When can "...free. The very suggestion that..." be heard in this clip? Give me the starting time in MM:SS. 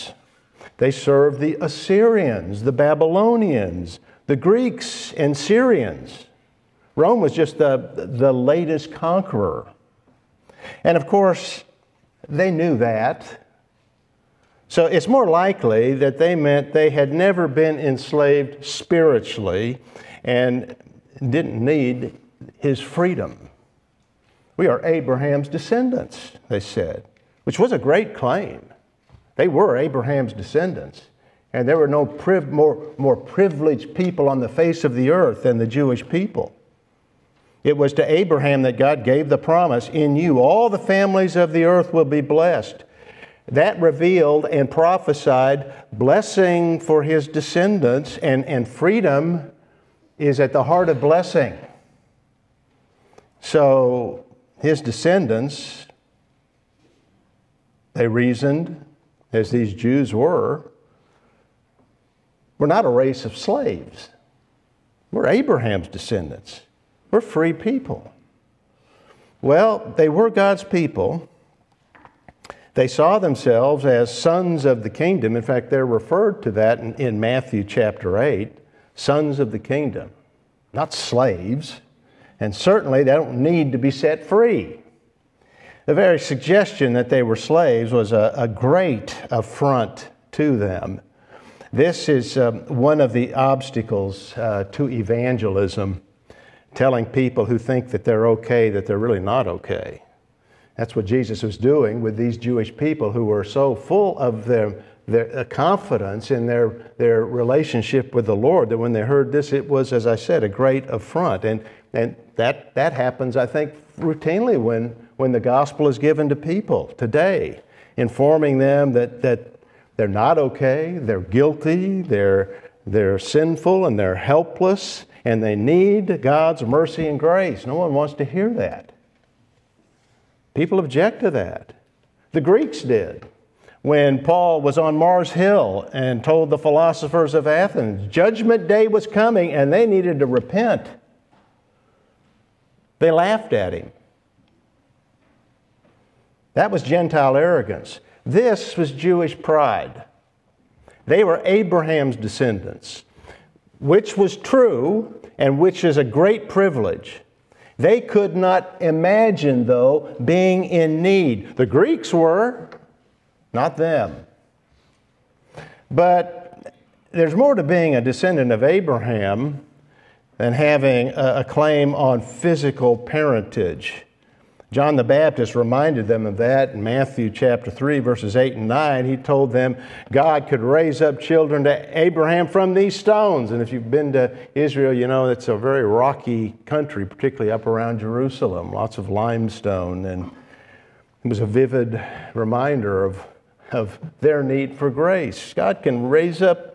01:24.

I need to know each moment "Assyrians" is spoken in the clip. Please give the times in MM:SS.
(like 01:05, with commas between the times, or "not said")
00:01.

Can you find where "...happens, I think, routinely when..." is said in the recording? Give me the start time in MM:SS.
01:52.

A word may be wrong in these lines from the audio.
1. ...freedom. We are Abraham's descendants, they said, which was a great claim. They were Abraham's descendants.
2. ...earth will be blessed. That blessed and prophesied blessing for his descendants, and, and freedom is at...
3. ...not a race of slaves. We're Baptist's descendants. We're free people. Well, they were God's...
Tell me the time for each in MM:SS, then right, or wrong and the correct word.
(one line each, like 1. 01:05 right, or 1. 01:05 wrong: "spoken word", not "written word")
1. 00:22 right
2. 00:41 wrong: "revealed", not "blessed"
3. 01:02 wrong: "Abraham", not "Baptist".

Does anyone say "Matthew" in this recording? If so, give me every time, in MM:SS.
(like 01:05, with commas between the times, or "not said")
01:17, 02:56.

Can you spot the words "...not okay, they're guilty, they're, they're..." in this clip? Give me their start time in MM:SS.
02:00.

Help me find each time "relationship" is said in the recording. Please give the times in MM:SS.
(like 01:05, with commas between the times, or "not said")
01:47.